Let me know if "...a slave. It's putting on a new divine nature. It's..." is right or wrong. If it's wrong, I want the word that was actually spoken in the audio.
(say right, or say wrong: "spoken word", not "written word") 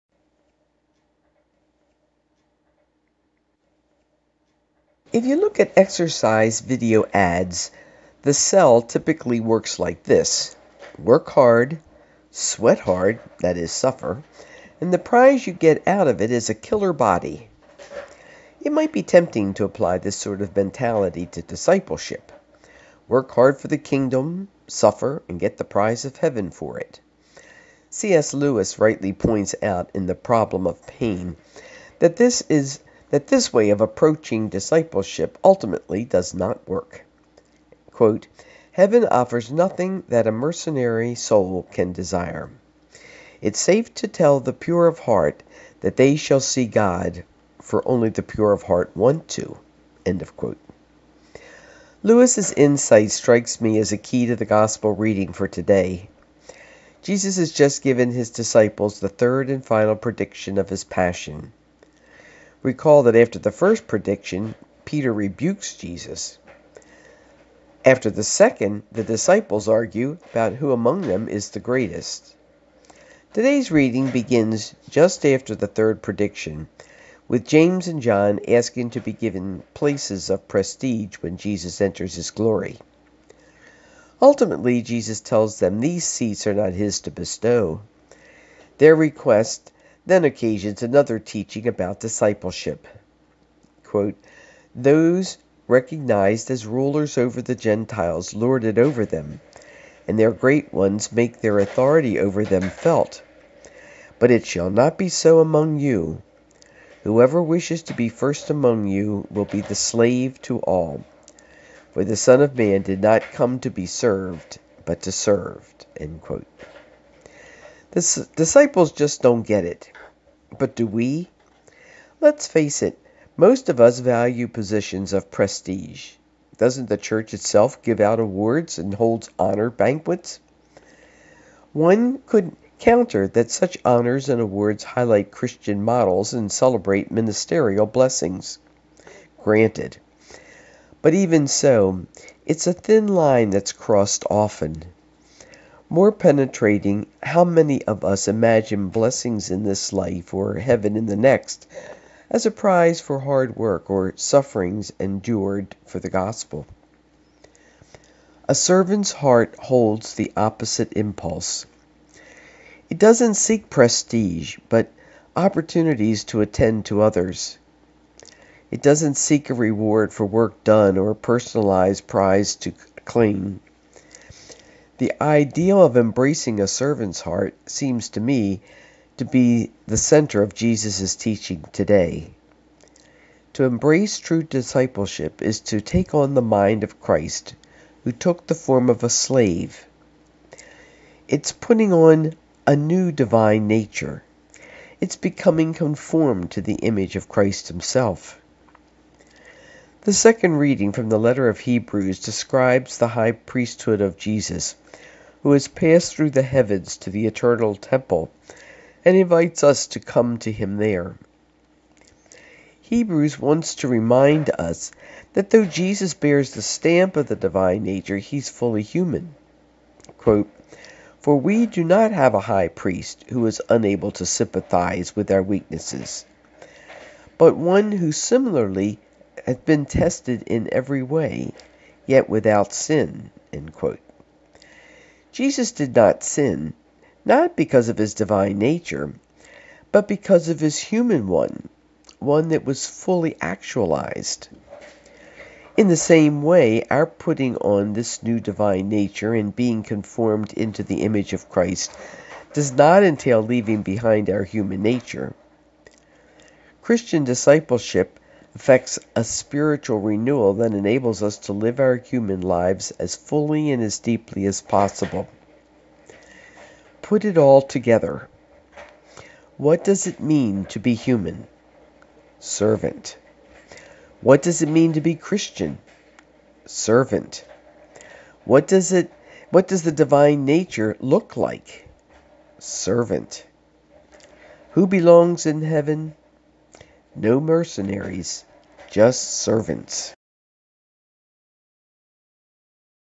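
right.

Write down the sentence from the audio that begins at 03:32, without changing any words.
Hebrews wants to remind us that though Jesus bears the stamp of the divine nature, he's fully human.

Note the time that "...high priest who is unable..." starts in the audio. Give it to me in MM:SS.
03:42.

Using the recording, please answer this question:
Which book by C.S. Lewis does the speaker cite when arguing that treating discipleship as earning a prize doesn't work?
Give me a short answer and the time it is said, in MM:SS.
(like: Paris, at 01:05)
The Problem of Pain, at 00:30.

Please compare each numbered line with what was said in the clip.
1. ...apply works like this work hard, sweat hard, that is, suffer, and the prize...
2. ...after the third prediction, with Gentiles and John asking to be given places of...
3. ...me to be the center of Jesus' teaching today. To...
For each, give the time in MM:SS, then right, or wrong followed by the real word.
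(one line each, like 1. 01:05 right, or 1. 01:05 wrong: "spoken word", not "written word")
1. 00:08 wrong: "typically", not "apply"
2. 01:15 wrong: "James", not "Gentiles"
3. 02:58 right.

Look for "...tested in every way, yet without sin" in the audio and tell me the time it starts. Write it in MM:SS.
03:49.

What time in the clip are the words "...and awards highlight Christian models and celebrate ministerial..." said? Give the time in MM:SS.
02:14.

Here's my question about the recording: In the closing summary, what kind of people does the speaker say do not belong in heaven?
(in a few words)
Mercenaries.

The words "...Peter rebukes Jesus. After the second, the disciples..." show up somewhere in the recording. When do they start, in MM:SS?
01:04.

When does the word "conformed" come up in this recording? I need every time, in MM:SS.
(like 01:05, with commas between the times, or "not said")
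03:15, 04:09.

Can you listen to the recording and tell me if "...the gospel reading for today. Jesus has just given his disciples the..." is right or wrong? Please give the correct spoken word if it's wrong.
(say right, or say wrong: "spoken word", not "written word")
right.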